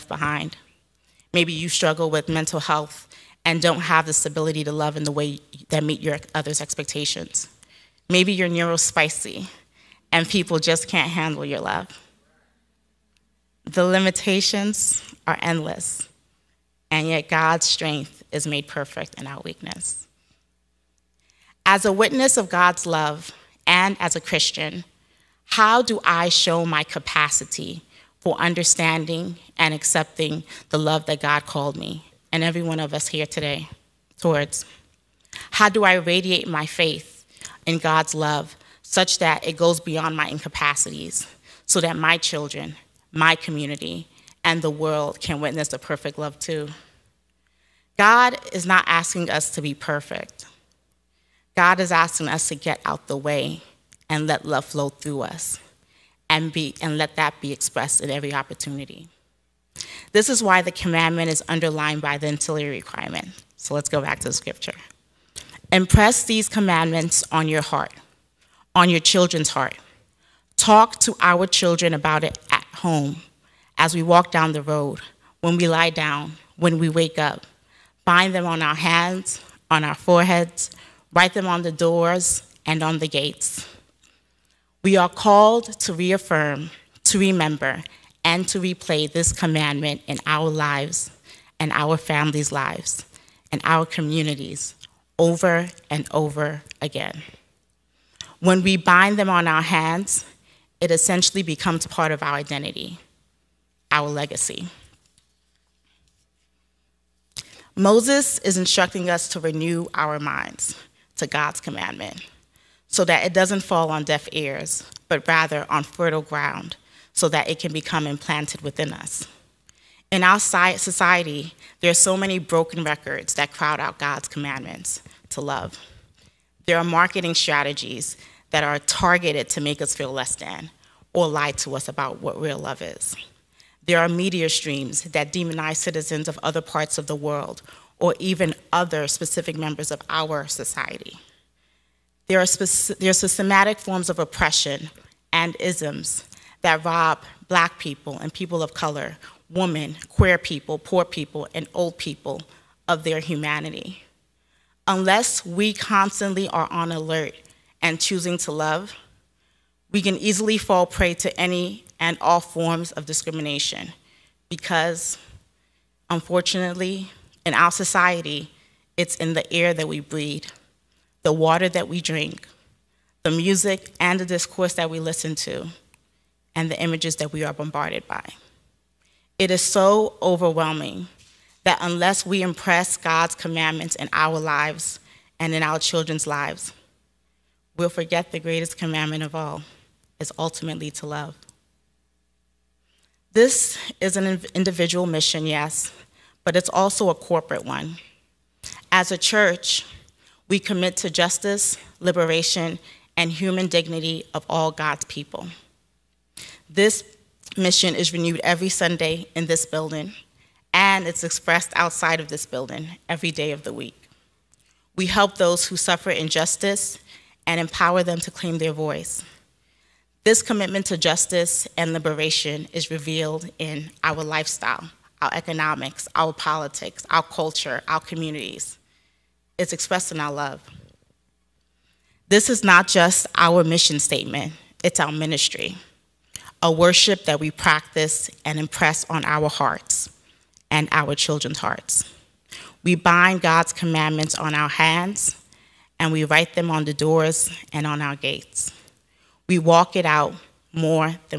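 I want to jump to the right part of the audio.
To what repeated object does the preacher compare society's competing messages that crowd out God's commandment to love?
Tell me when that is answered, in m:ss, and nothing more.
2:02.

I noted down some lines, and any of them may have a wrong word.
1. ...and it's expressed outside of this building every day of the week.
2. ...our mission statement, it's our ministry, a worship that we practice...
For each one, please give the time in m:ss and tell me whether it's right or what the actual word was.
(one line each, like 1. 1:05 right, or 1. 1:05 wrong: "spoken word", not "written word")
1. 3:30 right
2. 3:53 right.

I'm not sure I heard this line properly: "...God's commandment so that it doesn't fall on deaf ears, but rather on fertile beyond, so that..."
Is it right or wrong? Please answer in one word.
wrong.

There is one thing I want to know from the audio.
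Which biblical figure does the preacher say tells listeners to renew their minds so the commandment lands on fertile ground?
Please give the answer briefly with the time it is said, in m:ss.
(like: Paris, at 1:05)
Moses, at 1:47.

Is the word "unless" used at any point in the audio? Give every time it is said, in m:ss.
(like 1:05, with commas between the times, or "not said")
2:34, 3:01.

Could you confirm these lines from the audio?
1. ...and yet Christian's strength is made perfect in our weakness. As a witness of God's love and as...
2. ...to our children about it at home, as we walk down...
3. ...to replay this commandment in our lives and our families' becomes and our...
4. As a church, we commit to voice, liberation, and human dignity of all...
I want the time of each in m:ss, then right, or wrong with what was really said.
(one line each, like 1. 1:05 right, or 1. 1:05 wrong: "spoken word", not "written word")
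1. 0:16 wrong: "God", not "Christian"
2. 1:10 right
3. 1:28 wrong: "lives", not "becomes"
4. 3:18 wrong: "justice", not "voice".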